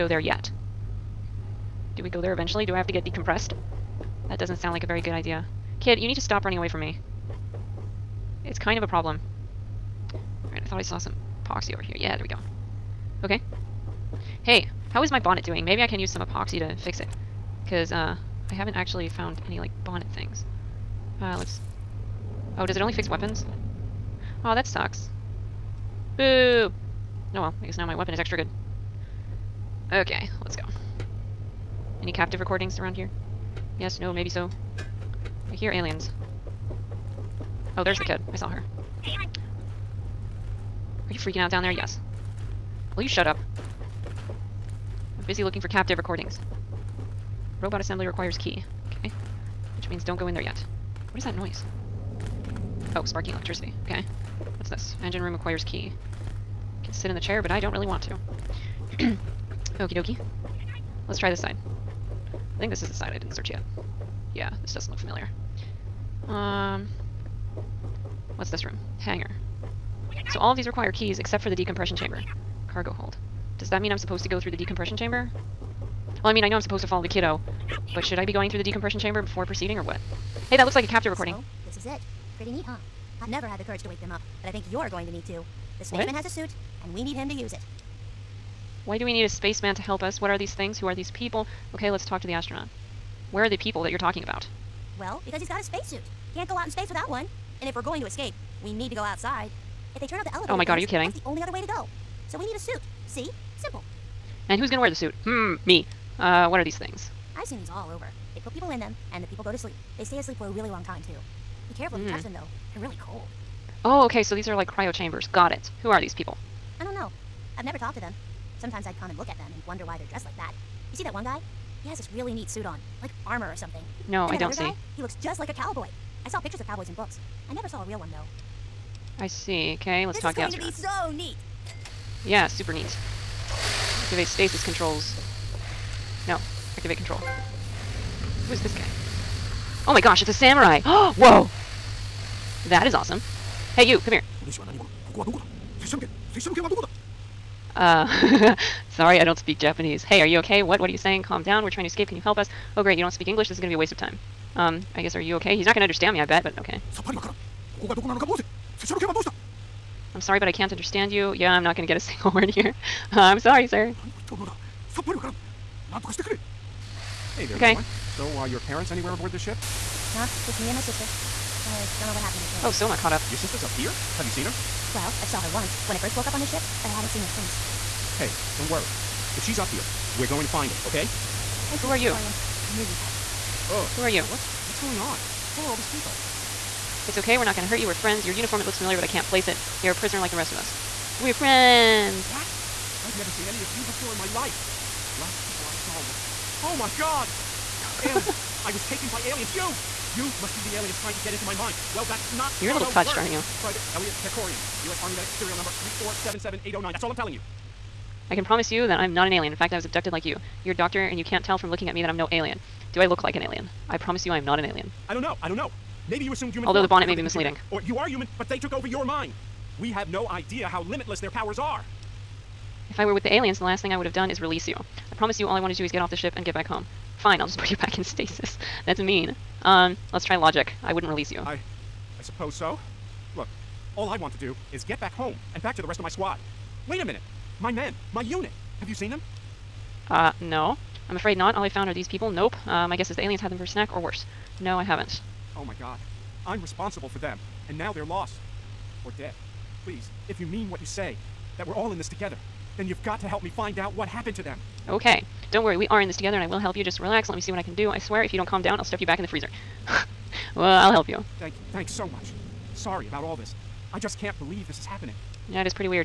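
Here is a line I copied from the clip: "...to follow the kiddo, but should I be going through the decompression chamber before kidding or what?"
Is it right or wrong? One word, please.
wrong.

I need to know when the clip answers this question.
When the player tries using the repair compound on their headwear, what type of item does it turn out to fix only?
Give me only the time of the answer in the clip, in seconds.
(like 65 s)
22 s.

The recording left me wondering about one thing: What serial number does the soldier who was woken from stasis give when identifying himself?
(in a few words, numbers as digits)
3477809.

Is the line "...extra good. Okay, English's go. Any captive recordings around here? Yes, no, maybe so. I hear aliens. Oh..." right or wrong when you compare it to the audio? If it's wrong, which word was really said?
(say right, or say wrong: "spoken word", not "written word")
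wrong: "Let", not "English".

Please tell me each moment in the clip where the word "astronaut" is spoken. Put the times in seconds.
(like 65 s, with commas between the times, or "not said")
92 s, 130 s.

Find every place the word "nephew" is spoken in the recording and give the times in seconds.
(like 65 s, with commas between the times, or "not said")
not said.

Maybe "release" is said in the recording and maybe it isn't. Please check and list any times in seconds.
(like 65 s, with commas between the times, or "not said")
224 s, 231 s.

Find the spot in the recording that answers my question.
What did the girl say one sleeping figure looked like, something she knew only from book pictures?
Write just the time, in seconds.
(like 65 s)
124 s.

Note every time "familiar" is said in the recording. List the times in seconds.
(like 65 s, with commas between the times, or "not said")
64 s, 188 s.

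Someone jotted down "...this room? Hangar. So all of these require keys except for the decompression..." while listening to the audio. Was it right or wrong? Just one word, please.
right.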